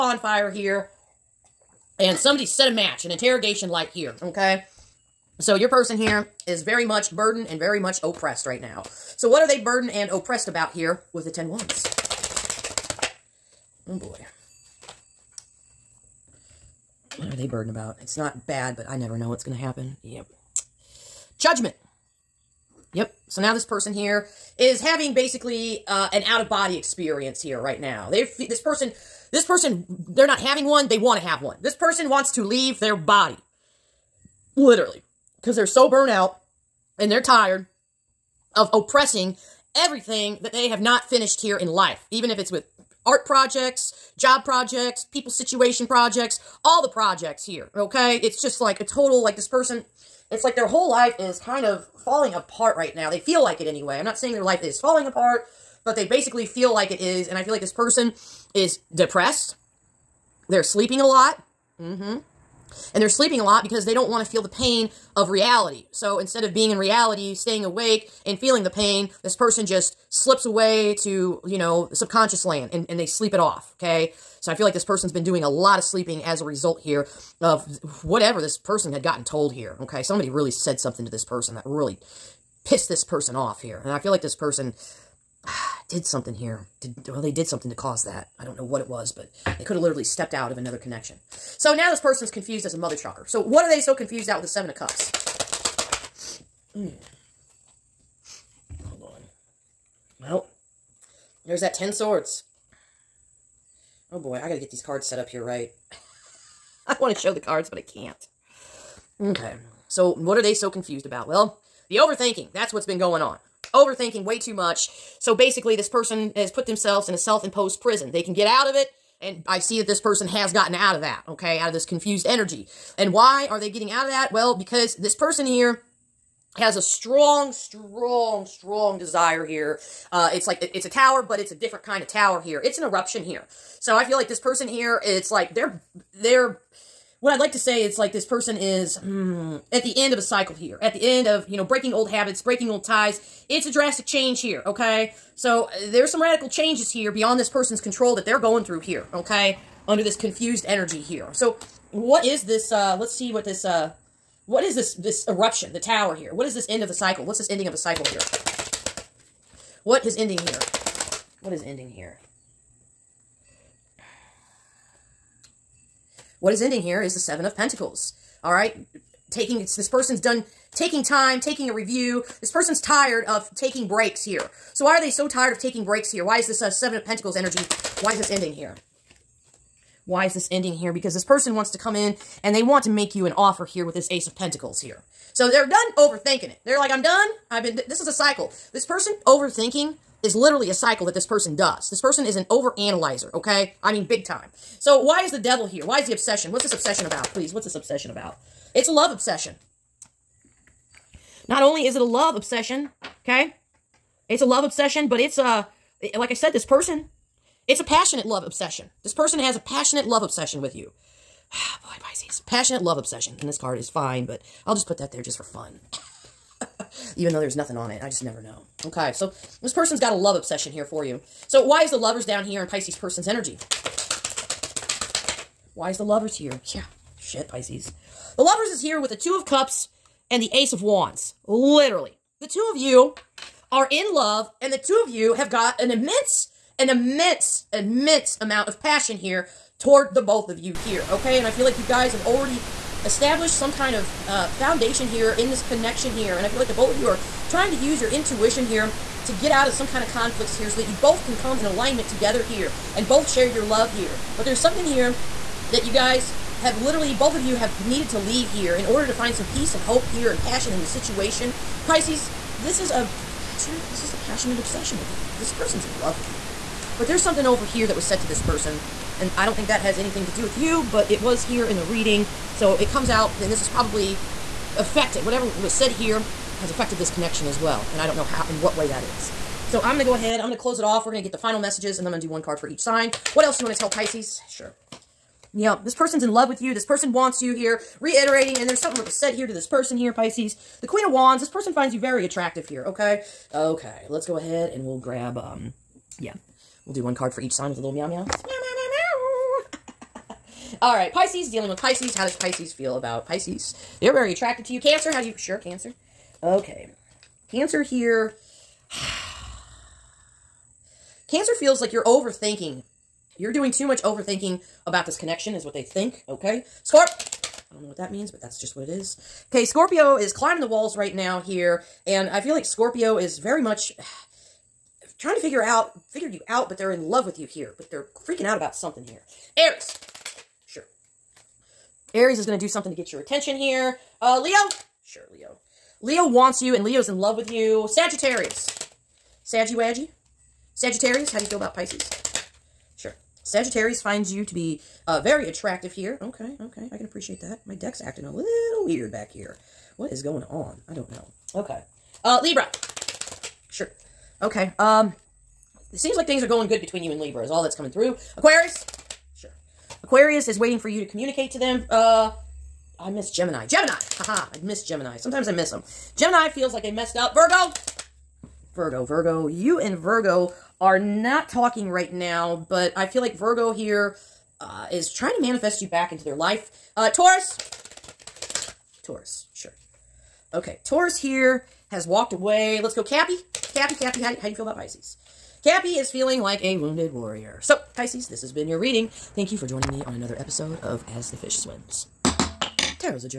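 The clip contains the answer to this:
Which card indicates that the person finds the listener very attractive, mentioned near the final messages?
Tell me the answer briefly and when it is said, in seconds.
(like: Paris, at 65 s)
Queen of Wands, at 290 s.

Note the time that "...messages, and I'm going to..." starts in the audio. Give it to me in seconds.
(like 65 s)
281 s.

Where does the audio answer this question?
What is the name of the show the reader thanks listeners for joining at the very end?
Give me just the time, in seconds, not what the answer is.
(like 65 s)
391 s.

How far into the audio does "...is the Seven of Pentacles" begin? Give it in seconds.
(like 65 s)
167 s.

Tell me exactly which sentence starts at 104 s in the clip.
Oh boy, I gotta get these cards set up here right.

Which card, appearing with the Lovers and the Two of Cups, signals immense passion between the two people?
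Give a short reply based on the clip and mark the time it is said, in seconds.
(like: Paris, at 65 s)
Ace of Wands, at 230 s.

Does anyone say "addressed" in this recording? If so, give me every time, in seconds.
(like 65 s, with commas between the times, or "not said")
not said.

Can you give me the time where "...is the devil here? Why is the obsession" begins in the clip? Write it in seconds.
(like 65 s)
195 s.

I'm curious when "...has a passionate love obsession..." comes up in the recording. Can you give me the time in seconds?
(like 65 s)
209 s.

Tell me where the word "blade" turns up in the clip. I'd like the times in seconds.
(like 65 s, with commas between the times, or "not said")
not said.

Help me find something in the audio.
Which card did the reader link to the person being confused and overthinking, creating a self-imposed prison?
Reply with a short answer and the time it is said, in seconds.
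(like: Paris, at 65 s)
Seven of Cups, at 94 s.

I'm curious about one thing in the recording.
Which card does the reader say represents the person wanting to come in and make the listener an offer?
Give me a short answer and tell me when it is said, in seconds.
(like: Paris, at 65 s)
Ace of Pentacles, at 184 s.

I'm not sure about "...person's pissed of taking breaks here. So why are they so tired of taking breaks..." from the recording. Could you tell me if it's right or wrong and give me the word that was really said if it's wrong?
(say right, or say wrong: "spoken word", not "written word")
wrong: "tired", not "pissed".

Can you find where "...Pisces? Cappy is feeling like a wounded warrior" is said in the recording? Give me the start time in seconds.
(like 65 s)
384 s.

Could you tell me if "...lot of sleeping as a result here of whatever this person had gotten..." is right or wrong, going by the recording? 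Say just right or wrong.
right.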